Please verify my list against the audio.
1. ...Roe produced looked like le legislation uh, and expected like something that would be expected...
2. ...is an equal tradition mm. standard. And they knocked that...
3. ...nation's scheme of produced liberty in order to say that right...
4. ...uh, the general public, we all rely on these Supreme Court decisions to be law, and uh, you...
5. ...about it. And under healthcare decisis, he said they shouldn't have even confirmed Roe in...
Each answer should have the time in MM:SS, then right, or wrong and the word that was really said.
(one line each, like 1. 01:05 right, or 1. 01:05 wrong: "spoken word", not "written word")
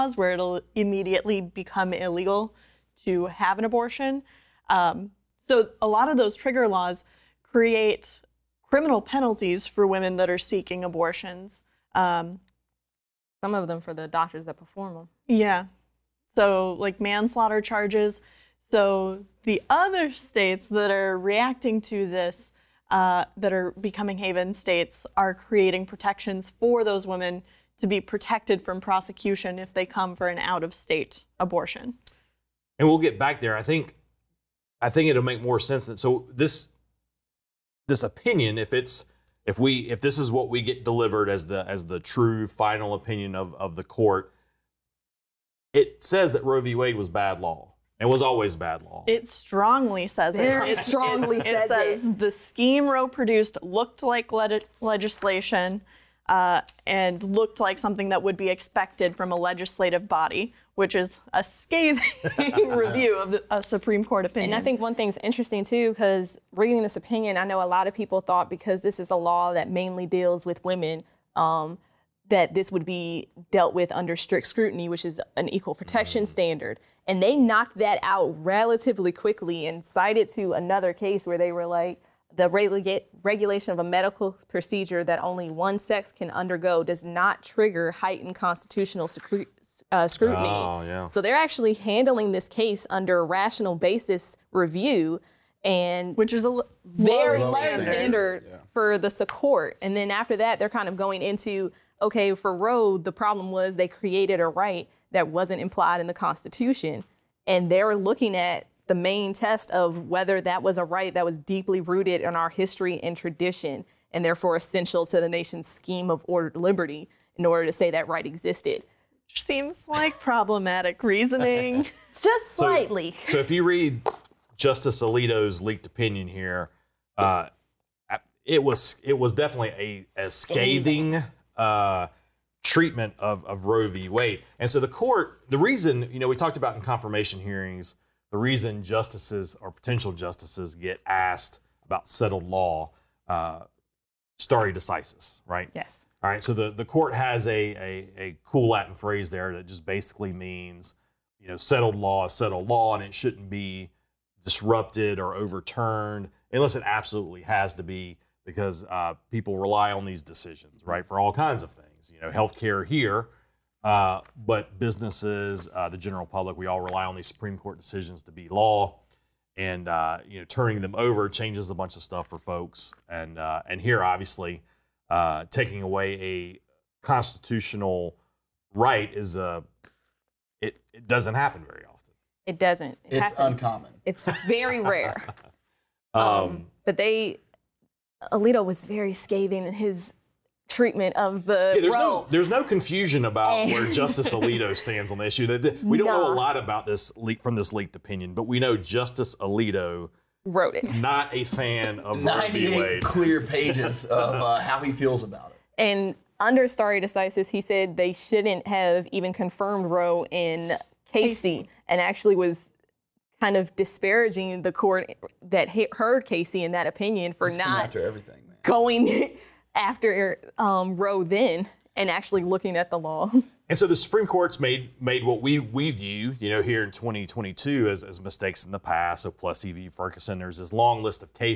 1. 00:52 wrong: "looked", not "expected"
2. 01:15 wrong: "protection", not "tradition"
3. 01:55 wrong: "ordered", not "produced"
4. 02:45 right
5. 03:25 wrong: "stare", not "healthcare".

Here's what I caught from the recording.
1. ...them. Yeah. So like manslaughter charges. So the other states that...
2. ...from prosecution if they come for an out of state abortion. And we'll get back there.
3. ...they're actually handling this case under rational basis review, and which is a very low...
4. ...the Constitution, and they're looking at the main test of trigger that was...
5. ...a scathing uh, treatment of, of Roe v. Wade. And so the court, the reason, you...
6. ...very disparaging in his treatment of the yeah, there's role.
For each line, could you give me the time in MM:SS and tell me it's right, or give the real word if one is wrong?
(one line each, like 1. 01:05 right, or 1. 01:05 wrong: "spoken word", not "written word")
1. 00:14 right
2. 00:28 right
3. 01:31 right
4. 01:46 wrong: "whether", not "trigger"
5. 02:10 right
6. 03:08 wrong: "scathing", not "disparaging".